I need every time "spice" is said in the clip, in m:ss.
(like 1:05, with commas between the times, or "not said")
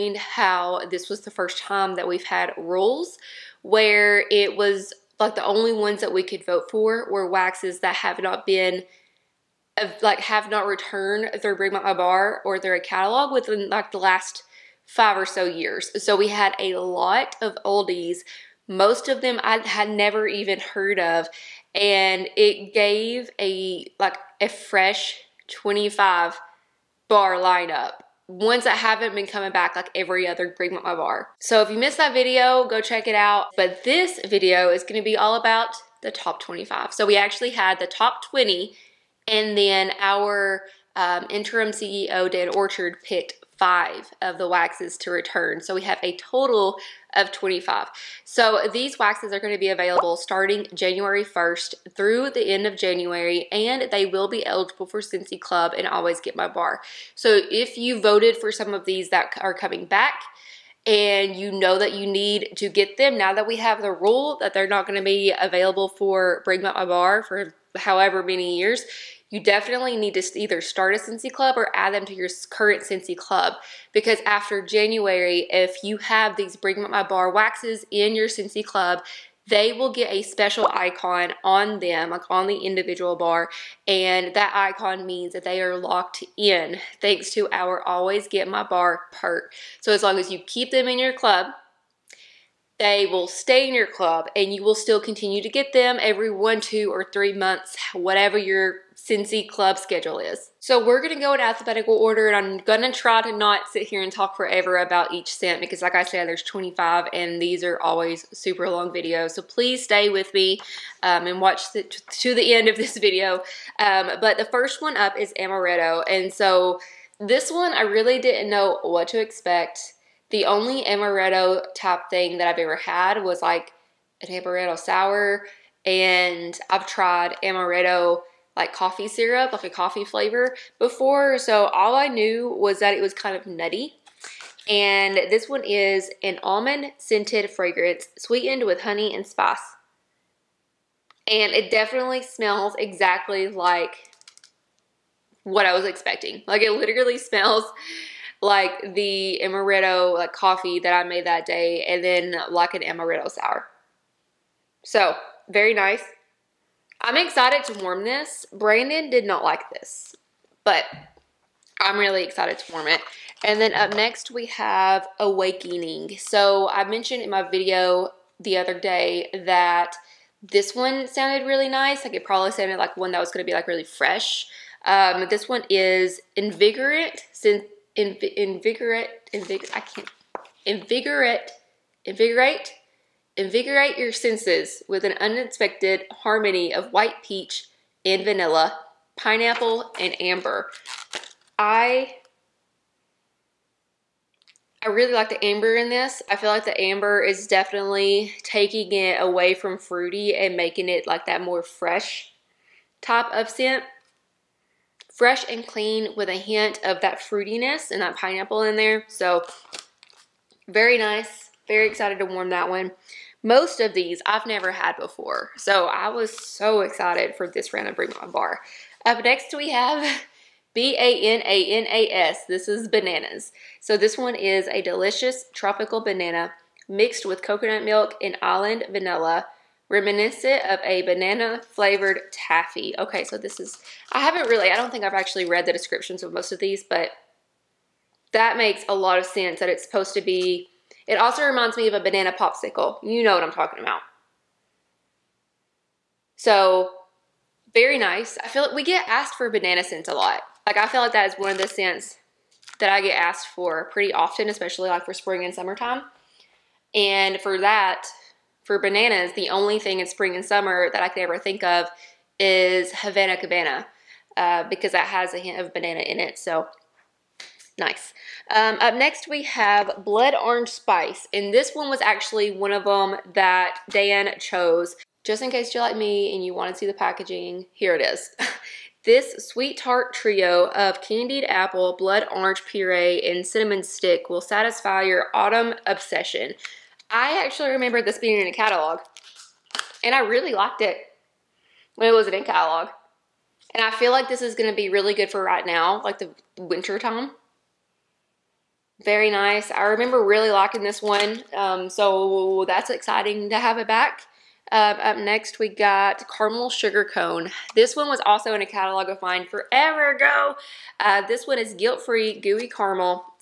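2:19, 4:30.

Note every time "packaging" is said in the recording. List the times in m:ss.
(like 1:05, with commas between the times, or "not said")
4:36.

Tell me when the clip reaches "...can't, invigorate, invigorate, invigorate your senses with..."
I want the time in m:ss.
2:59.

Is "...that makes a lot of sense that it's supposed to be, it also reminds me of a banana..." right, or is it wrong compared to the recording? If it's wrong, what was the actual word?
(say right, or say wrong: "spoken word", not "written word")
right.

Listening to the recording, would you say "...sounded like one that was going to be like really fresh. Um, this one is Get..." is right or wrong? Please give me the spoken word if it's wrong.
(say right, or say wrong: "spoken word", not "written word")
wrong: "Invigorant", not "Get".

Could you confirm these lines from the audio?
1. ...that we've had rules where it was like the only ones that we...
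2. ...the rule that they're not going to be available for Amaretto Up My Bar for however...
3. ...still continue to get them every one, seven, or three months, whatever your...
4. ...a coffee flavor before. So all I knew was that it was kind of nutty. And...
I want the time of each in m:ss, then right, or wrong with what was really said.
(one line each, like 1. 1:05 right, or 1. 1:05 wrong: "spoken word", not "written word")
1. 0:01 right
2. 1:03 wrong: "Bring", not "Amaretto"
3. 1:34 wrong: "two", not "seven"
4. 2:09 right.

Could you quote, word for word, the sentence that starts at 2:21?
And it definitely smells exactly like what I was expecting.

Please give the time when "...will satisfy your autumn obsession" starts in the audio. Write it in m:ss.
4:44.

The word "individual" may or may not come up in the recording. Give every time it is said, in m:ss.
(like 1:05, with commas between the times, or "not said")
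1:22.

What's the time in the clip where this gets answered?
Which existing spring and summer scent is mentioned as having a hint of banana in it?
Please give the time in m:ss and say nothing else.
4:22.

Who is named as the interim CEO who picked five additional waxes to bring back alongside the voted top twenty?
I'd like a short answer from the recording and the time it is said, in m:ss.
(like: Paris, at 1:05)
Dan Orchard, at 0:42.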